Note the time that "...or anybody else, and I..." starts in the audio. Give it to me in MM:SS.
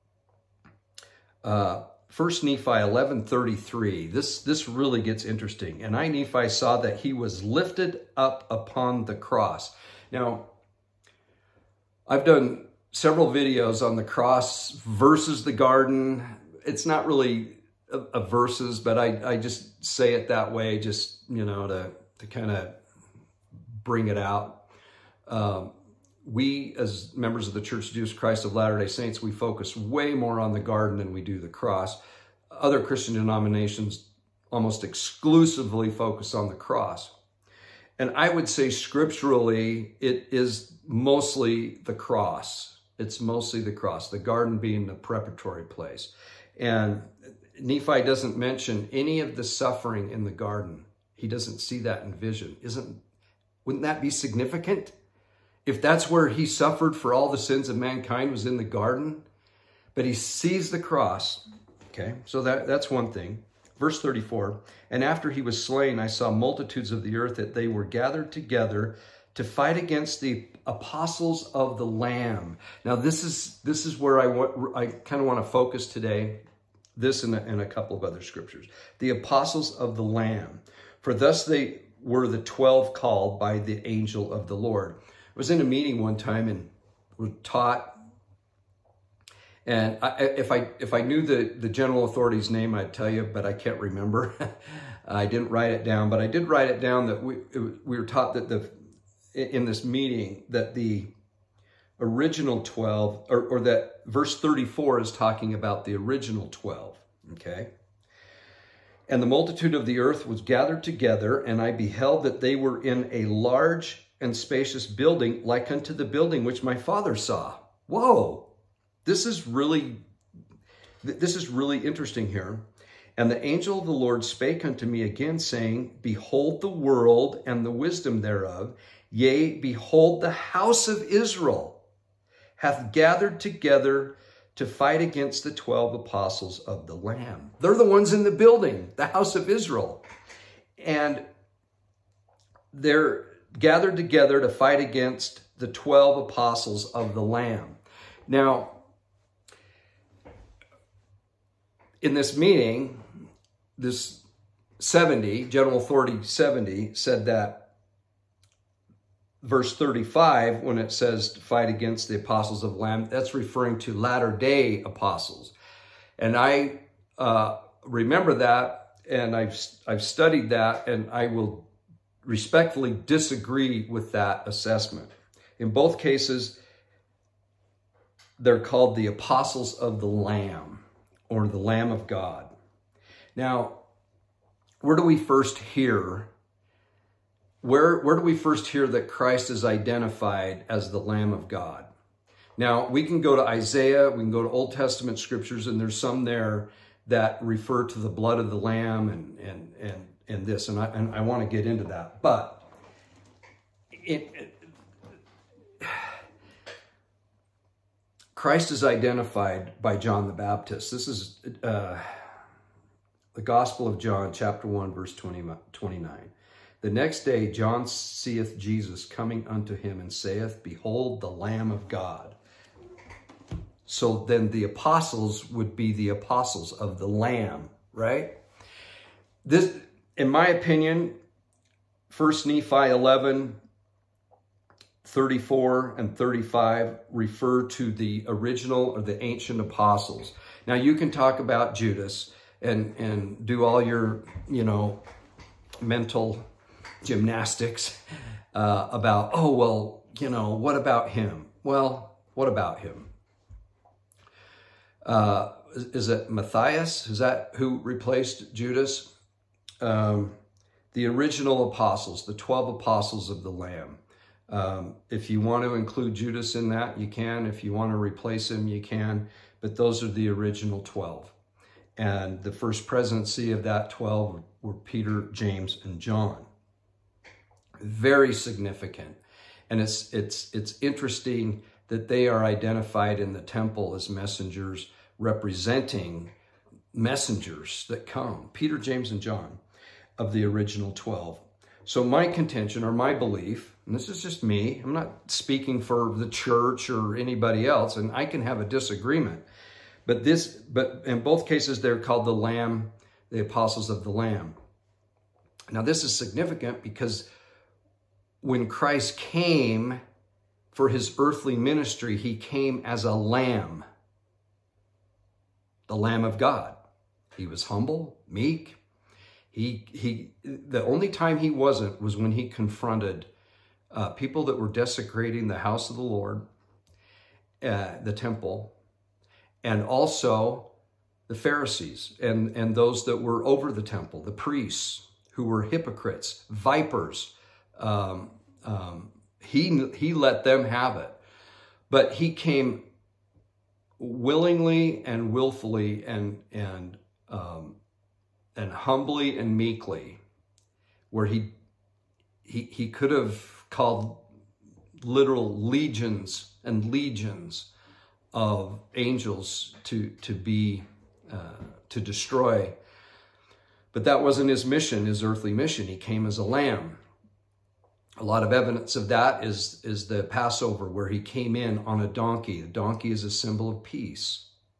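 04:56.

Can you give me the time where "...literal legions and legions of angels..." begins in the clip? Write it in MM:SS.
05:55.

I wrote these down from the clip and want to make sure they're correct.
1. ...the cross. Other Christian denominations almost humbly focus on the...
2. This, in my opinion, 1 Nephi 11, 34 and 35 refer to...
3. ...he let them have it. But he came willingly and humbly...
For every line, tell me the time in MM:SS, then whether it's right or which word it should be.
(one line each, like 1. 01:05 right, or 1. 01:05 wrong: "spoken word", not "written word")
1. 00:31 wrong: "exclusively", not "humbly"
2. 03:49 right
3. 05:39 wrong: "willfully", not "humbly".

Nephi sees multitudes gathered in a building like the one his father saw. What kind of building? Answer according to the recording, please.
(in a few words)
Large and spacious building.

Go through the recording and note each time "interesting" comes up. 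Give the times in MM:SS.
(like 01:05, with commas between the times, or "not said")
00:05, 02:01, 04:40.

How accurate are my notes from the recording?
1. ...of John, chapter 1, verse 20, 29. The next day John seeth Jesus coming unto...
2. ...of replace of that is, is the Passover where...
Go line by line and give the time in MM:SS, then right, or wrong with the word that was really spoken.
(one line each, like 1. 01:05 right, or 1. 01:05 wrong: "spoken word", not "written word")
1. 03:33 right
2. 06:08 wrong: "evidence", not "replace".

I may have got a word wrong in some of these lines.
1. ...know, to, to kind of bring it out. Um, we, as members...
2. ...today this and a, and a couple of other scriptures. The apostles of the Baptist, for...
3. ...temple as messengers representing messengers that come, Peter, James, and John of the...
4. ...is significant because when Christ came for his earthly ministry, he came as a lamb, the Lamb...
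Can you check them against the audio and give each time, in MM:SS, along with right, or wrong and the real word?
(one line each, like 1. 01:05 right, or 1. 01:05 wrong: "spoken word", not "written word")
1. 00:21 right
2. 01:15 wrong: "Lamb", not "Baptist"
3. 04:43 right
4. 05:06 right.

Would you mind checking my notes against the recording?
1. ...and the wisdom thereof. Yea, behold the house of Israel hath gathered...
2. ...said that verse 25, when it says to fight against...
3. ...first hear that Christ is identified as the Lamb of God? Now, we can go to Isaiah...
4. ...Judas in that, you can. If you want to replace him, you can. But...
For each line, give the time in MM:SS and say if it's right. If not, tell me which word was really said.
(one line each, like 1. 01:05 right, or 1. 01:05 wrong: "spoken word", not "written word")
1. 02:07 right
2. 02:36 wrong: "35", not "25"
3. 03:08 right
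4. 04:26 right.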